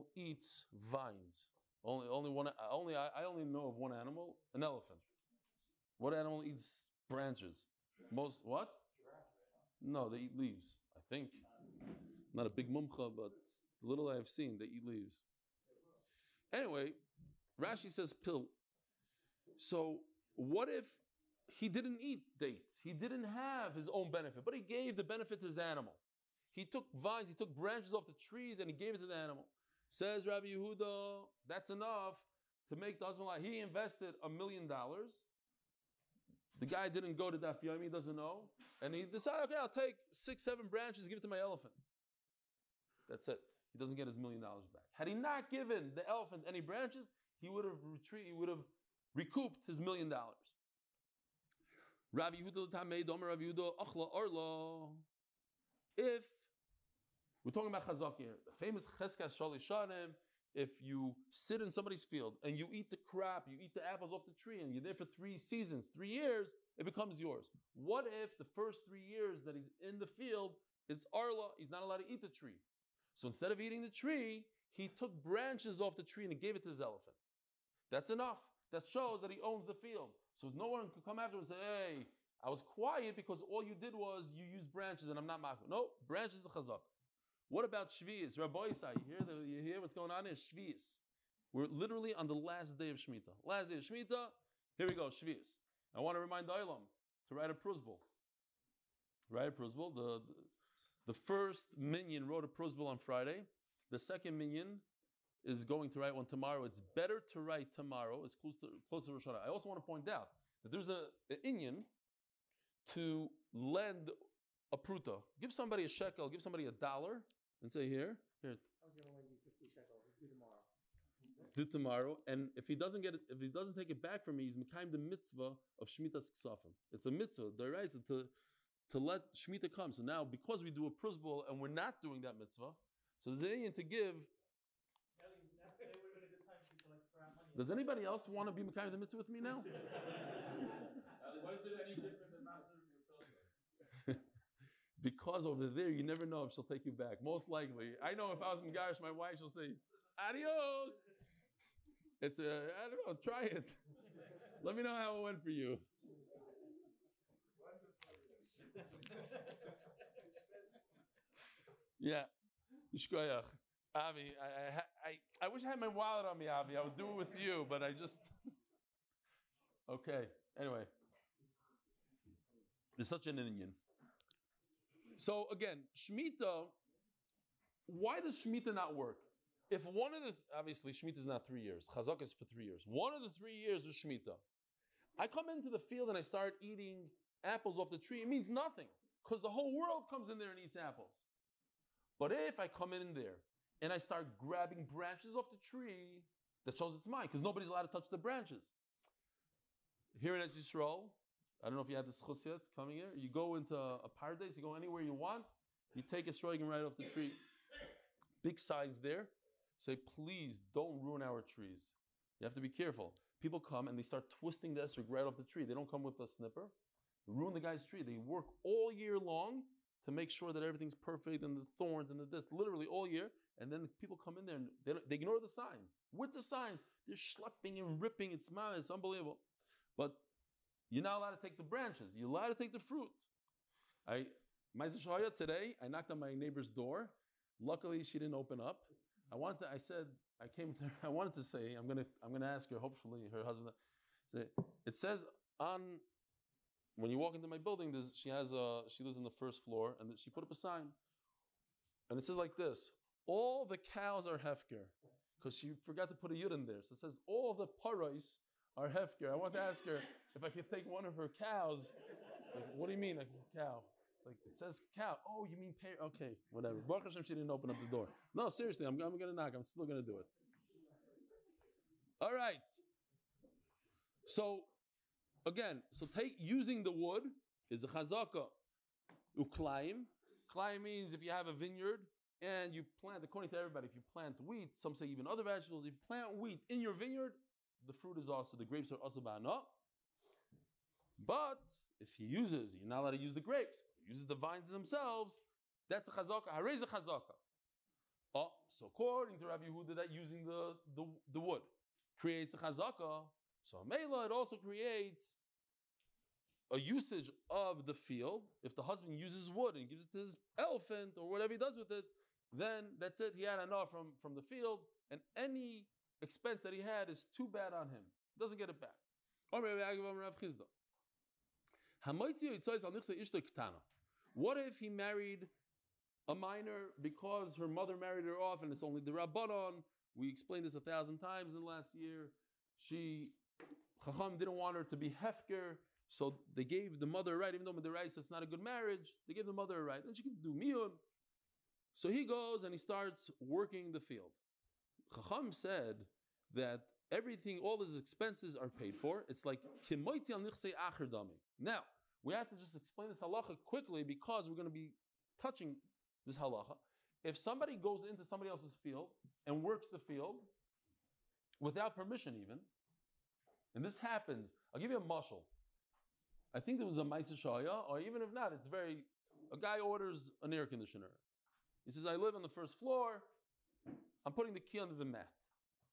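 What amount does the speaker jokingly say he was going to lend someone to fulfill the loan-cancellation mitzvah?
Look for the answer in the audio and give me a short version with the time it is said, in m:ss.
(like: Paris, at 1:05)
50 shekel, at 1:59.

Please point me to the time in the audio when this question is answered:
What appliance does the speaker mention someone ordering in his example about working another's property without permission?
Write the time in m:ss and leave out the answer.
6:10.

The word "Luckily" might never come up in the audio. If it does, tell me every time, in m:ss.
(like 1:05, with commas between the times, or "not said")
3:57.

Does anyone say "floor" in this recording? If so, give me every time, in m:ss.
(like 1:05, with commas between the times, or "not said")
4:09, 6:12.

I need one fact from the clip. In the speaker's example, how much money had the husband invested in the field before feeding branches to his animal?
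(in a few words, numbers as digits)
a million dollars.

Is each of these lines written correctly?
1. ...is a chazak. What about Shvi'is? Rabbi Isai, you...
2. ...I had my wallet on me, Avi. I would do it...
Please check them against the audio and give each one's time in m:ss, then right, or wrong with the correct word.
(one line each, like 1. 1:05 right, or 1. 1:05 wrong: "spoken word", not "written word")
1. 1:26 right
2. 2:45 right.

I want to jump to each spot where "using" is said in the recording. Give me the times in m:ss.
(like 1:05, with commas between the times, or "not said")
4:36, 5:00.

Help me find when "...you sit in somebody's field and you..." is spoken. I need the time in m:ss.
1:00.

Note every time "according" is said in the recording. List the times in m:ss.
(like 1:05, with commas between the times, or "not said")
4:43, 4:58.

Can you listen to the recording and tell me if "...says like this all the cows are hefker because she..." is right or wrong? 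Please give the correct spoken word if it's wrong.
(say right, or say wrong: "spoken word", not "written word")
right.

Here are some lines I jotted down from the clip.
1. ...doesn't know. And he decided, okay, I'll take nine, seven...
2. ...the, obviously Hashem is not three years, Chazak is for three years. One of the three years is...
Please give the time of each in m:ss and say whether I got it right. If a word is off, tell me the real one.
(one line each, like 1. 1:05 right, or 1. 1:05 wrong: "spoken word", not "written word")
1. 0:37 wrong: "six", not "nine"
2. 3:00 wrong: "Shemitah", not "Hashem".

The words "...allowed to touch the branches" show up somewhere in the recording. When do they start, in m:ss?
3:17.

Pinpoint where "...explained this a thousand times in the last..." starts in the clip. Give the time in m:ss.
5:30.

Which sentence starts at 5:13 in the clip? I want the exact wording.
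He had enough from, from the field, and any expense that he had is too bad on him.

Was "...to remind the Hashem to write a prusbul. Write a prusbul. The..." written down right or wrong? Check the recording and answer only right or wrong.
wrong.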